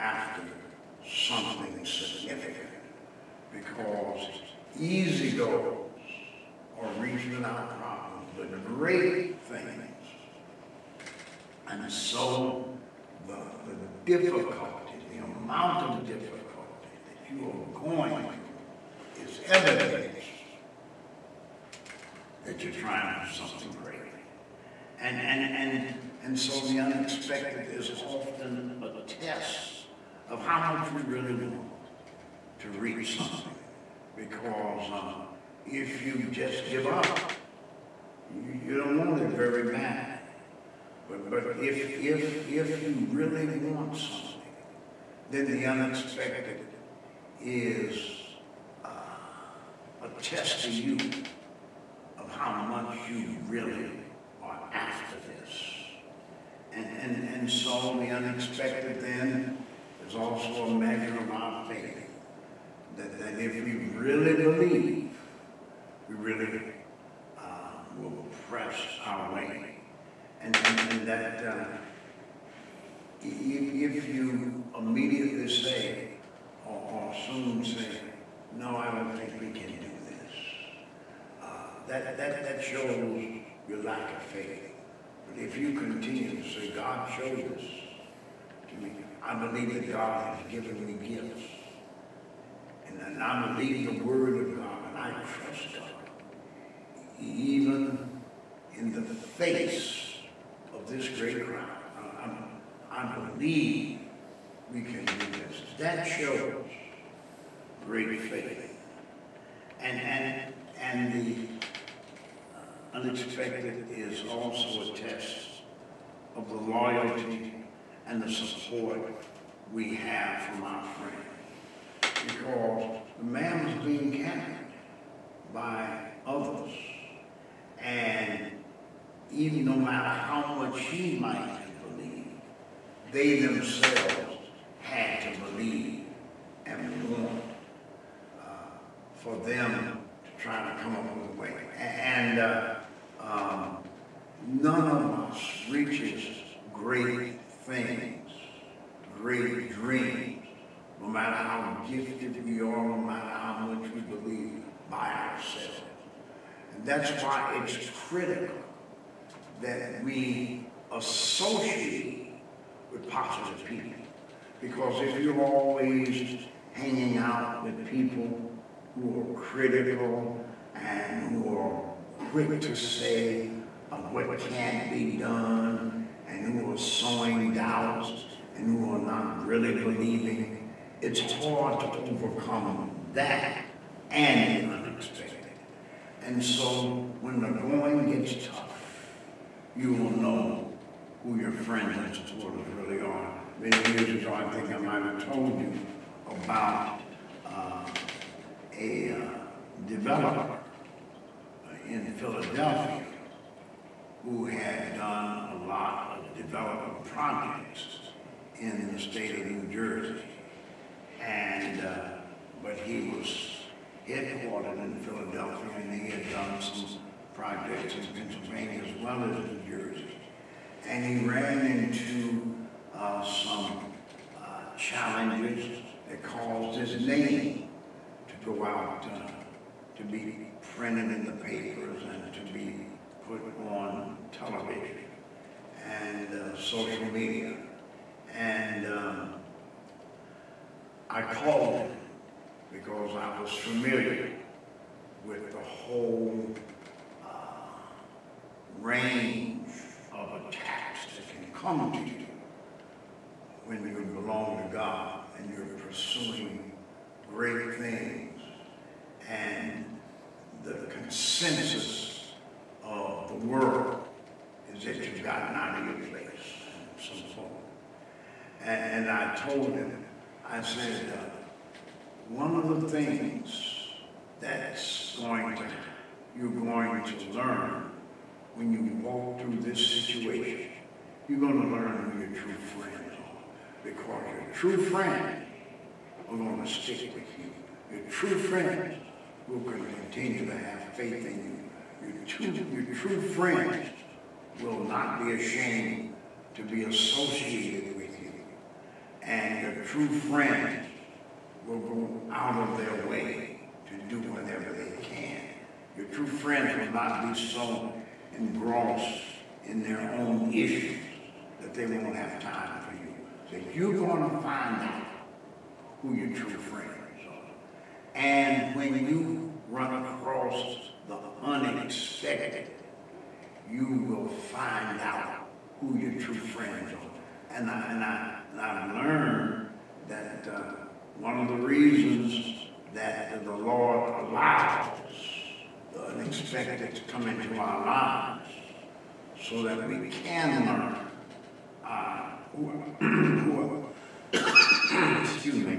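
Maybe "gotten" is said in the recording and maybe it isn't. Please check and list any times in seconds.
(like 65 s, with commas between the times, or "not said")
265 s.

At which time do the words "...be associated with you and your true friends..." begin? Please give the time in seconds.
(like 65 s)
296 s.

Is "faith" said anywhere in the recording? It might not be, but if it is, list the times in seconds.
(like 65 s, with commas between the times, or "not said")
61 s, 84 s, 108 s, 290 s.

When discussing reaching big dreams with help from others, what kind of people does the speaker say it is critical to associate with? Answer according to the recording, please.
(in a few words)
positive people.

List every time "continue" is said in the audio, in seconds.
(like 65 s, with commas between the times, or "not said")
85 s, 289 s.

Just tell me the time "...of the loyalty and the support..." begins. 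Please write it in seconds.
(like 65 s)
116 s.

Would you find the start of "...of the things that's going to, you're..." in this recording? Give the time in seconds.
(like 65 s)
272 s.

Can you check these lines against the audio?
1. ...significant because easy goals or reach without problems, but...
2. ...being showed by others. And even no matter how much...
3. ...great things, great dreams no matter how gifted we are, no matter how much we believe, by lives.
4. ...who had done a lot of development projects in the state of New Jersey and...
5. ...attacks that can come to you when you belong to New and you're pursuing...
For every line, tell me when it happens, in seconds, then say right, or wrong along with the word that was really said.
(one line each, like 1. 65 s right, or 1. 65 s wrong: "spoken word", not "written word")
1. 1 s right
2. 123 s wrong: "carried", not "showed"
3. 146 s wrong: "ourselves", not "lives"
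4. 204 s right
5. 250 s wrong: "God", not "New".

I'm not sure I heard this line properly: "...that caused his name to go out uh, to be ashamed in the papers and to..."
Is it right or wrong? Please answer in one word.
wrong.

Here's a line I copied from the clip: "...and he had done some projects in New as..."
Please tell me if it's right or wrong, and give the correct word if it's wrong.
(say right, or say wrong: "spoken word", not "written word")
wrong: "Pennsylvania", not "New".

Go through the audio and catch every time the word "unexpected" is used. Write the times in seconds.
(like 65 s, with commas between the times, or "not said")
26 s, 45 s, 58 s, 112 s, 184 s, 321 s, 336 s.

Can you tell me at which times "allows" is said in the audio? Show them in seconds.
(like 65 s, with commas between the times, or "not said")
334 s.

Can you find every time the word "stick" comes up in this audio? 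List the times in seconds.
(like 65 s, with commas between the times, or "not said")
286 s.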